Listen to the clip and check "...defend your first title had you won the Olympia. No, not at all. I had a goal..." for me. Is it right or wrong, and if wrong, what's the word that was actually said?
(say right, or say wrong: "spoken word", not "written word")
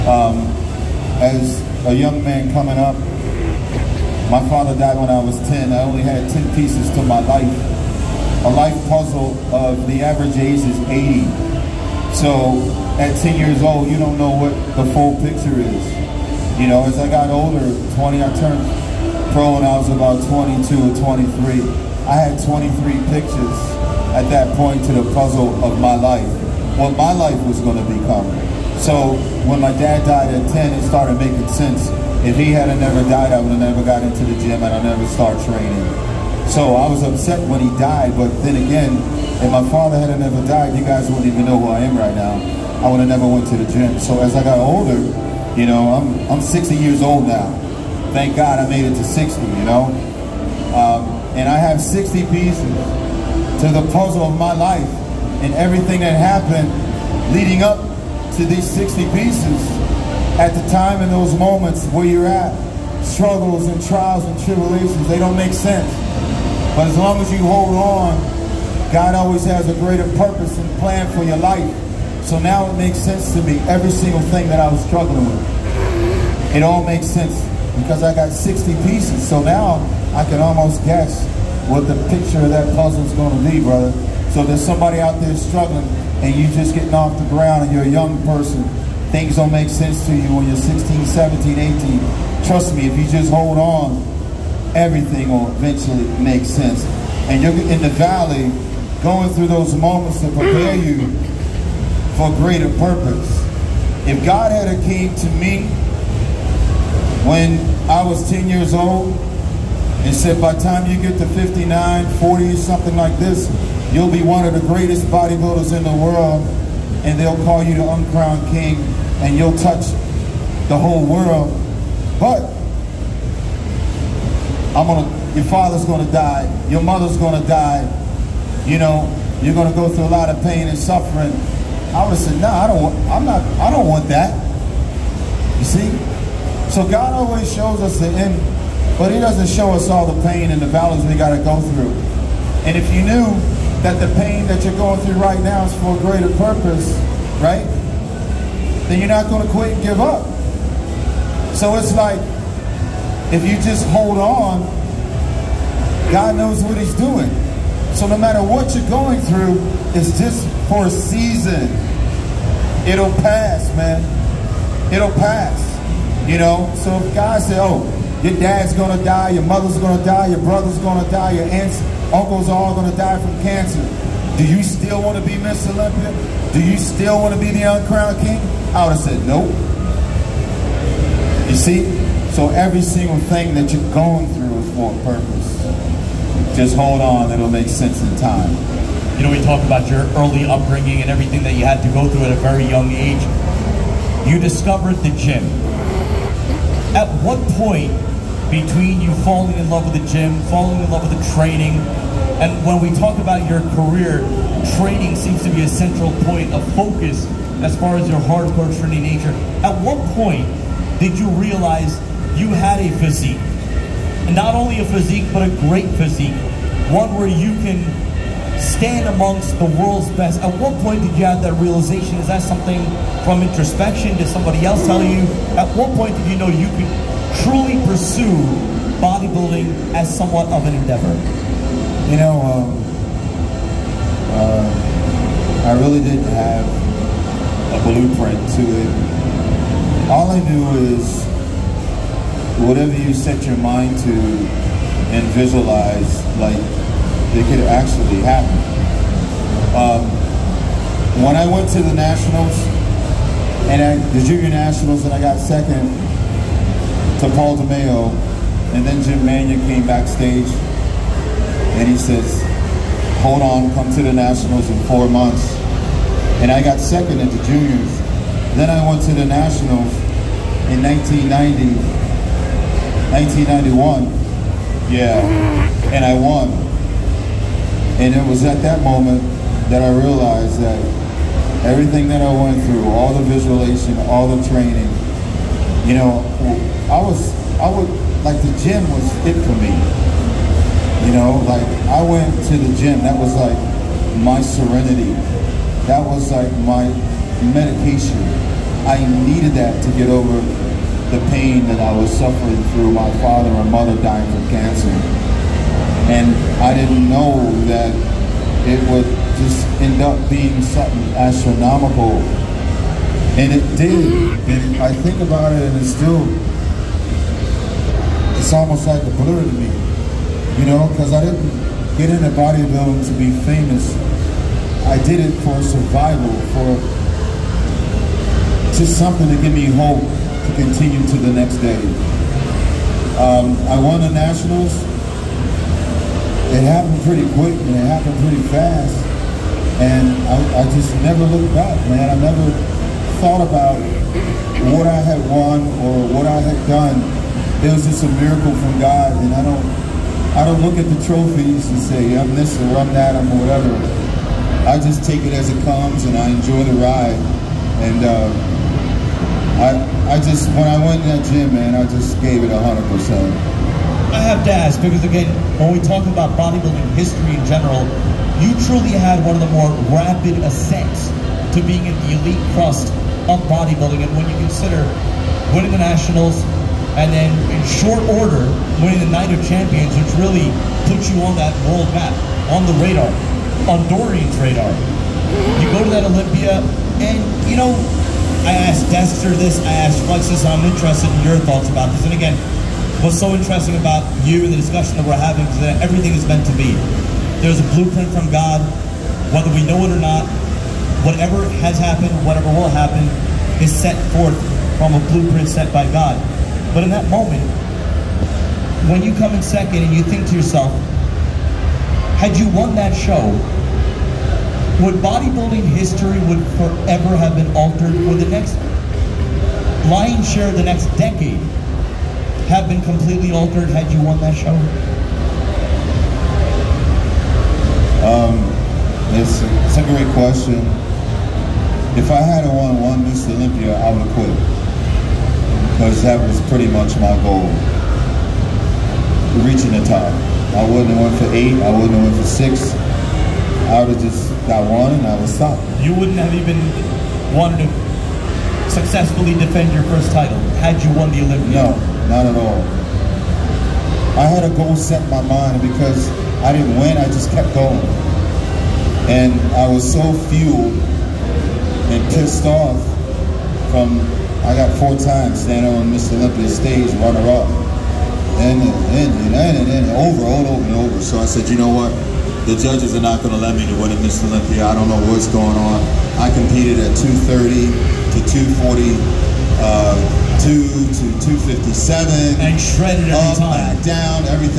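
right.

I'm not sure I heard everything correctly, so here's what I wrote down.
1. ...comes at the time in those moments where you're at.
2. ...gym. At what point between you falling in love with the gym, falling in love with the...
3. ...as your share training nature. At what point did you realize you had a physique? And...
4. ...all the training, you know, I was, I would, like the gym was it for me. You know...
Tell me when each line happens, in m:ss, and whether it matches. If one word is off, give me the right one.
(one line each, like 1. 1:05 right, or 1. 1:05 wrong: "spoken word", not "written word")
1. 0:59 wrong: "pieces", not "comes"
2. 3:15 right
3. 3:27 wrong: "hardcore", not "share"
4. 4:44 right.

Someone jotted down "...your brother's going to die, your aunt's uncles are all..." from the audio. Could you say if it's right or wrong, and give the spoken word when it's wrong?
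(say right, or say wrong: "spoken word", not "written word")
right.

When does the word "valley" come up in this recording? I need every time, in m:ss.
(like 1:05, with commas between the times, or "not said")
1:37, 2:20.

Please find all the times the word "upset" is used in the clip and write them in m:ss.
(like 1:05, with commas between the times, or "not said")
0:37.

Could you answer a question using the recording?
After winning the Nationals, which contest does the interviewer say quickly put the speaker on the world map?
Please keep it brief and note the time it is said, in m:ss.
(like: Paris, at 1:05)
Night of Champions, at 6:19.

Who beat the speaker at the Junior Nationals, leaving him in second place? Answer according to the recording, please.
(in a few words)
Paul DeMeo.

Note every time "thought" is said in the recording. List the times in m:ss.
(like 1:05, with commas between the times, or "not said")
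5:43, 6:31.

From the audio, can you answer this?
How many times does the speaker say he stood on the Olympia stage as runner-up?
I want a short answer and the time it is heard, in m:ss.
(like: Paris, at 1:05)
4, at 7:44.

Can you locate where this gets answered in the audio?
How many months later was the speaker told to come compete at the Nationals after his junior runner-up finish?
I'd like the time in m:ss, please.
4:24.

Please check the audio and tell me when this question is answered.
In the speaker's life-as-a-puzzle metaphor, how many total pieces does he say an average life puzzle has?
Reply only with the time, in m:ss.
0:10.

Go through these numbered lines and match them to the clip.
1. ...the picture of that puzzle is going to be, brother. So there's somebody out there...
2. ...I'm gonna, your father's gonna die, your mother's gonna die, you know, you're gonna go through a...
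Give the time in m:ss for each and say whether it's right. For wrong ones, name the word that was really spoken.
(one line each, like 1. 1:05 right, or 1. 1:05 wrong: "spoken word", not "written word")
1. 1:21 right
2. 2:04 right.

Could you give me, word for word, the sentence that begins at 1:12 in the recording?
So now it makes sense to me, every single thing that I was struggling with.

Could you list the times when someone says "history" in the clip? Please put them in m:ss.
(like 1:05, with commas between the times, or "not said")
6:06, 6:55.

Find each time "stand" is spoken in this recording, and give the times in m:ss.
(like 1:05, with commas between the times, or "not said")
3:38, 7:45.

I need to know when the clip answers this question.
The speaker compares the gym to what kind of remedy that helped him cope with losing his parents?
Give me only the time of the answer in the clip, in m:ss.
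4:57.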